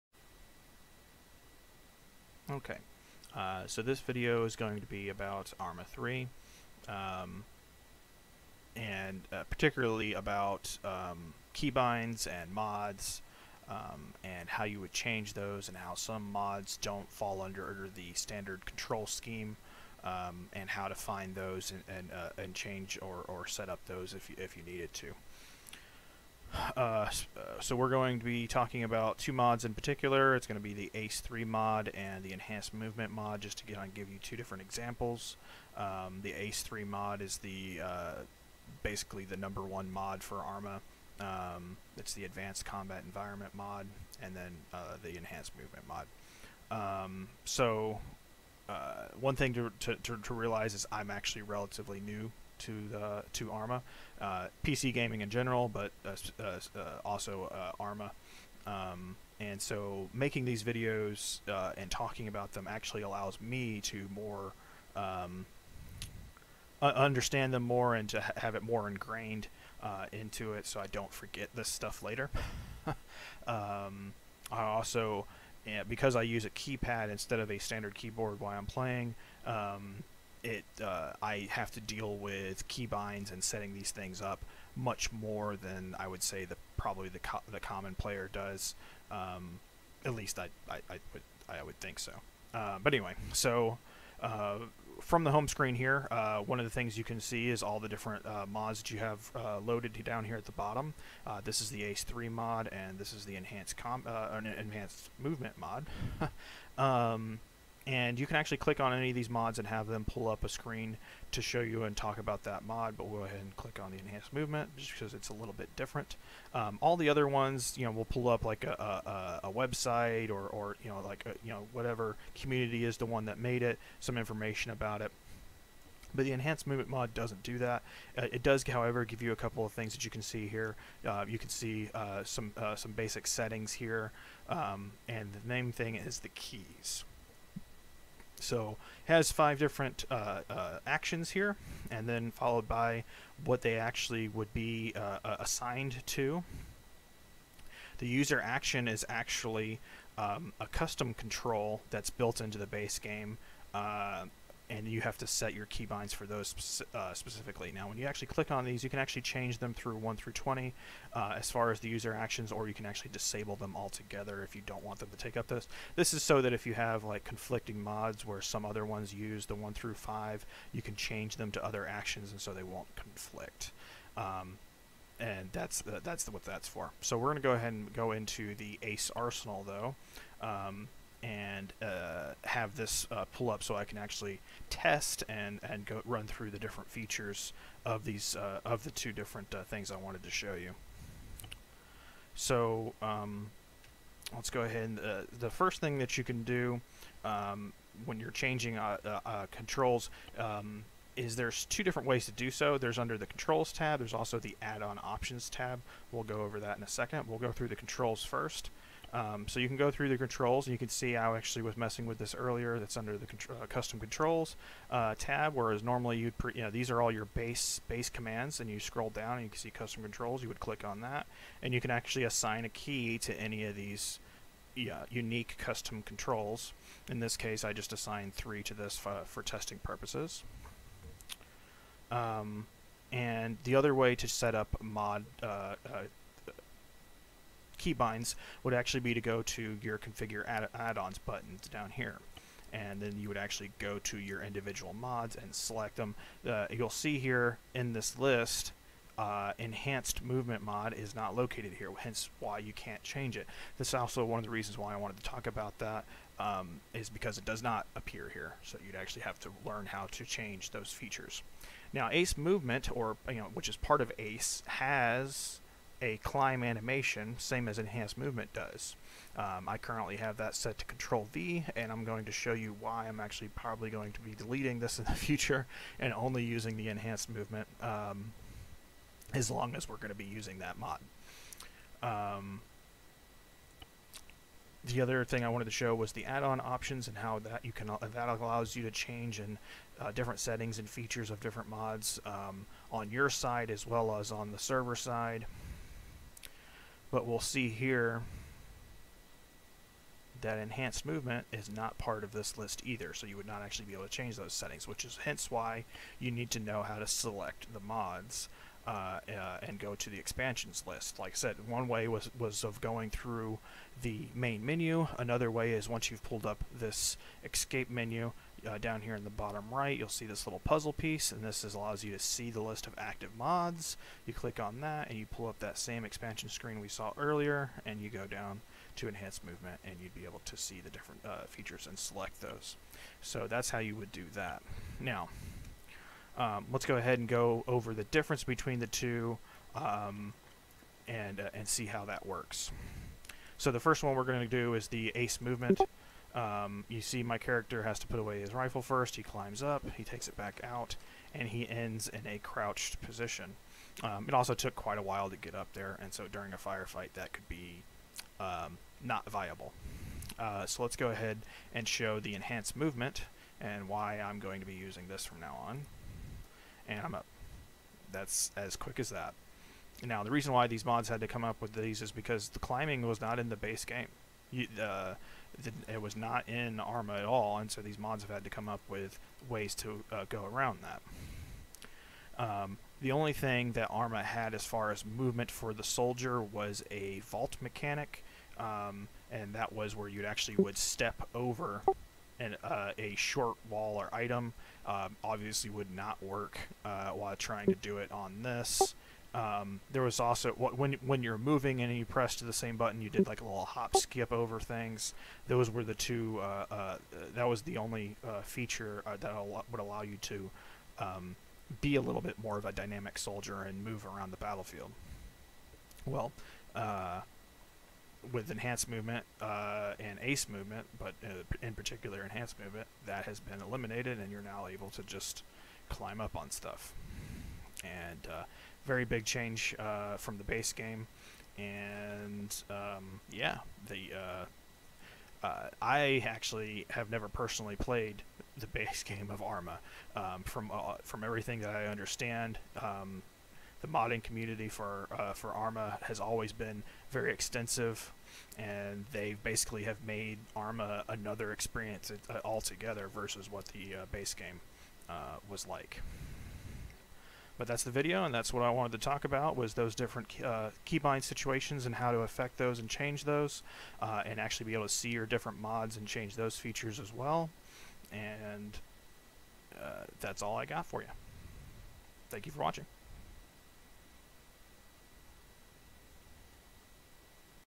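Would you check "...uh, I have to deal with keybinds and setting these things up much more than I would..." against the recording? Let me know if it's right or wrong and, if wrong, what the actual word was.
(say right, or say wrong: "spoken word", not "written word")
right.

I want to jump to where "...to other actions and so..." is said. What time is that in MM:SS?
02:51.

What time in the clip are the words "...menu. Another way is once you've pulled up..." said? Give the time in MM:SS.
05:14.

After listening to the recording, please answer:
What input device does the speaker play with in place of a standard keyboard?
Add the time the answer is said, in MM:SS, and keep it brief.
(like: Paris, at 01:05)
keypad, at 01:16.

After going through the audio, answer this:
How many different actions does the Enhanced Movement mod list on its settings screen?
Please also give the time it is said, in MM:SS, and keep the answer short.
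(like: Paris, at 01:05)
5, at 02:19.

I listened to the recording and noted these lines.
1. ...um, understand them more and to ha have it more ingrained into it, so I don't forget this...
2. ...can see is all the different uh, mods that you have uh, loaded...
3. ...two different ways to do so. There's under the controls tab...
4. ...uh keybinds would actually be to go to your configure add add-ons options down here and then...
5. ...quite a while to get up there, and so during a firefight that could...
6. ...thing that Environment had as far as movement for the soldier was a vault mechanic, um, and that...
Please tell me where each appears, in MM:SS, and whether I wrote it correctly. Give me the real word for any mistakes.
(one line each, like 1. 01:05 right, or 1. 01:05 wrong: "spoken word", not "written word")
1. 01:04 right
2. 01:37 right
3. 03:21 right
4. 03:55 wrong: "buttons", not "options"
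5. 05:54 right
6. 06:23 wrong: "Arma", not "Environment".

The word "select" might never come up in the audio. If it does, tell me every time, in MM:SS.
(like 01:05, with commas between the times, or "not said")
04:05, 05:07, 05:31.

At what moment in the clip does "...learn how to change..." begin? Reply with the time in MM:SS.
04:19.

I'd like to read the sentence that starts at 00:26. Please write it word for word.
Uh, uh, so we're going to be talking about two mods in particular.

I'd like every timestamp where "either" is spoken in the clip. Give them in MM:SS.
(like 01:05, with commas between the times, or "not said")
05:02.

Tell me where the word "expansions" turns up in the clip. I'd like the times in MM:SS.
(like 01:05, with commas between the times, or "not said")
05:10, 05:26.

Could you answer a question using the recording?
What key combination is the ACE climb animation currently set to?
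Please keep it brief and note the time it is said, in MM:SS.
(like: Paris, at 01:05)
Control V, at 04:30.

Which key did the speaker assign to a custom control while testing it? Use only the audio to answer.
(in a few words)
3.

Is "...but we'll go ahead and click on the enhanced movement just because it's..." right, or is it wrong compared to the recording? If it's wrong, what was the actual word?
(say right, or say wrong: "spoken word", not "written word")
right.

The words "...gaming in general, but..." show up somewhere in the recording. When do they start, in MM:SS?
00:54.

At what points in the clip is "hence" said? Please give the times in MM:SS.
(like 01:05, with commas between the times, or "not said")
04:11, 05:05.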